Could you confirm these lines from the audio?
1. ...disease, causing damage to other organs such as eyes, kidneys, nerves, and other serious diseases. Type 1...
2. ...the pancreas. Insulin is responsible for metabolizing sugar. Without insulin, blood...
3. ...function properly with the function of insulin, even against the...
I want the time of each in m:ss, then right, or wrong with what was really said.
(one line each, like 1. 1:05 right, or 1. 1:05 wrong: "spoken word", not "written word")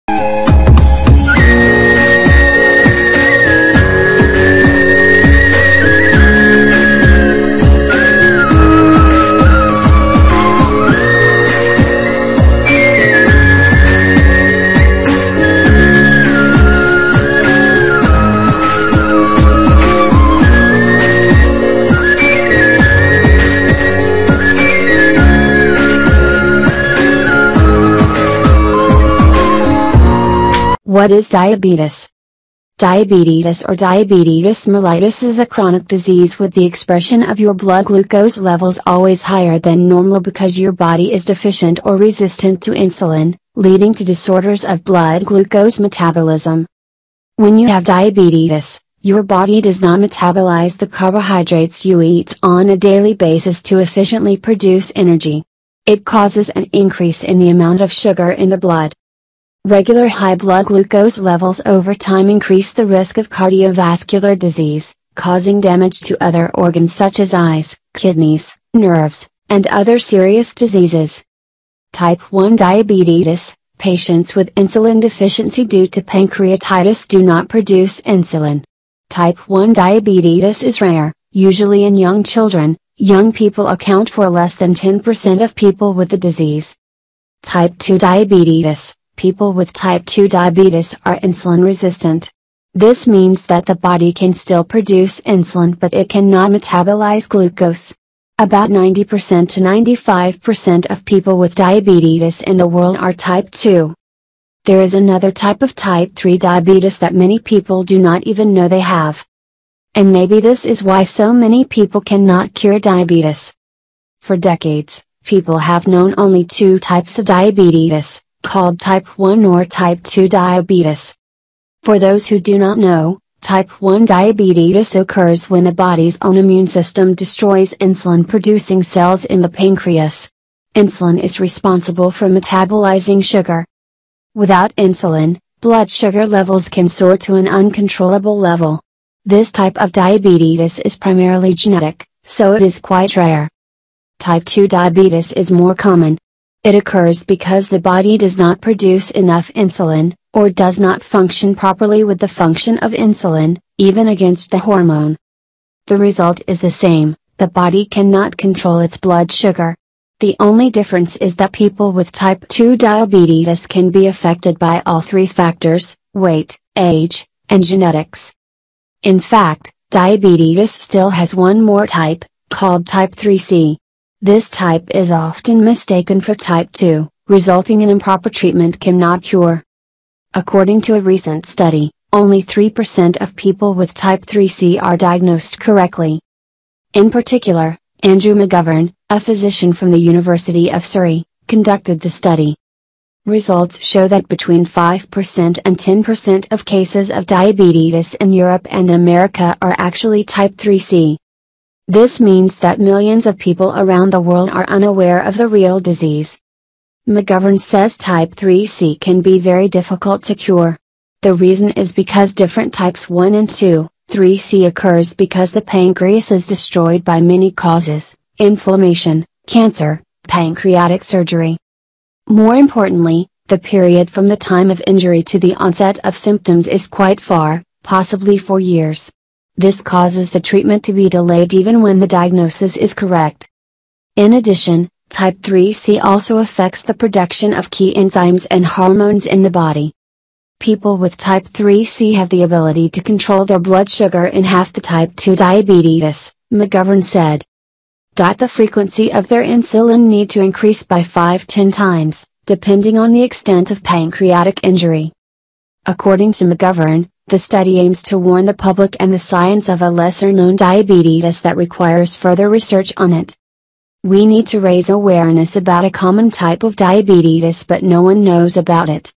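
1. 1:04 right
2. 2:09 right
3. 2:31 right.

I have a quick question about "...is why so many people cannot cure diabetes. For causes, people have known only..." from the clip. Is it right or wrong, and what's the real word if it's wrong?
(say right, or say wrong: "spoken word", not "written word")
wrong: "decades", not "causes".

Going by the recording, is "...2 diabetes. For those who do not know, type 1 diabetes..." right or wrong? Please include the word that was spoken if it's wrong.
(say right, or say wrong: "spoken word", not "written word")
right.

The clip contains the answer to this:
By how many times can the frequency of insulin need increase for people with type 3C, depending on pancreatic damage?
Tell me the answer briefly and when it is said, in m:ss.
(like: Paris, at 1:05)
5-10 times, at 4:11.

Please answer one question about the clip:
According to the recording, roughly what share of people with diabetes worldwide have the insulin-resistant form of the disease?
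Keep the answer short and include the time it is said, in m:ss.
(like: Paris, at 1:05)
90% to 95%, at 1:38.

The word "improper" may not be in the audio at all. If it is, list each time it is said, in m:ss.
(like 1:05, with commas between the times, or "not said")
2:57.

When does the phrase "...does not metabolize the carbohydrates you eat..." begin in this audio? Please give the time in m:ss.
0:49.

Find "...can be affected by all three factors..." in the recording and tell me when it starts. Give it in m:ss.
2:43.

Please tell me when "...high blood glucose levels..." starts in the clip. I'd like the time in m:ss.
1:00.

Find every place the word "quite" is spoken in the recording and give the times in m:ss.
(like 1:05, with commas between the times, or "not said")
2:22, 3:46.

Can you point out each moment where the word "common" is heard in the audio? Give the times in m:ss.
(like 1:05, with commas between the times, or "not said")
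2:25, 4:25.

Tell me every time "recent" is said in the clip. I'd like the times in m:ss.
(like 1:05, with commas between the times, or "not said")
3:01.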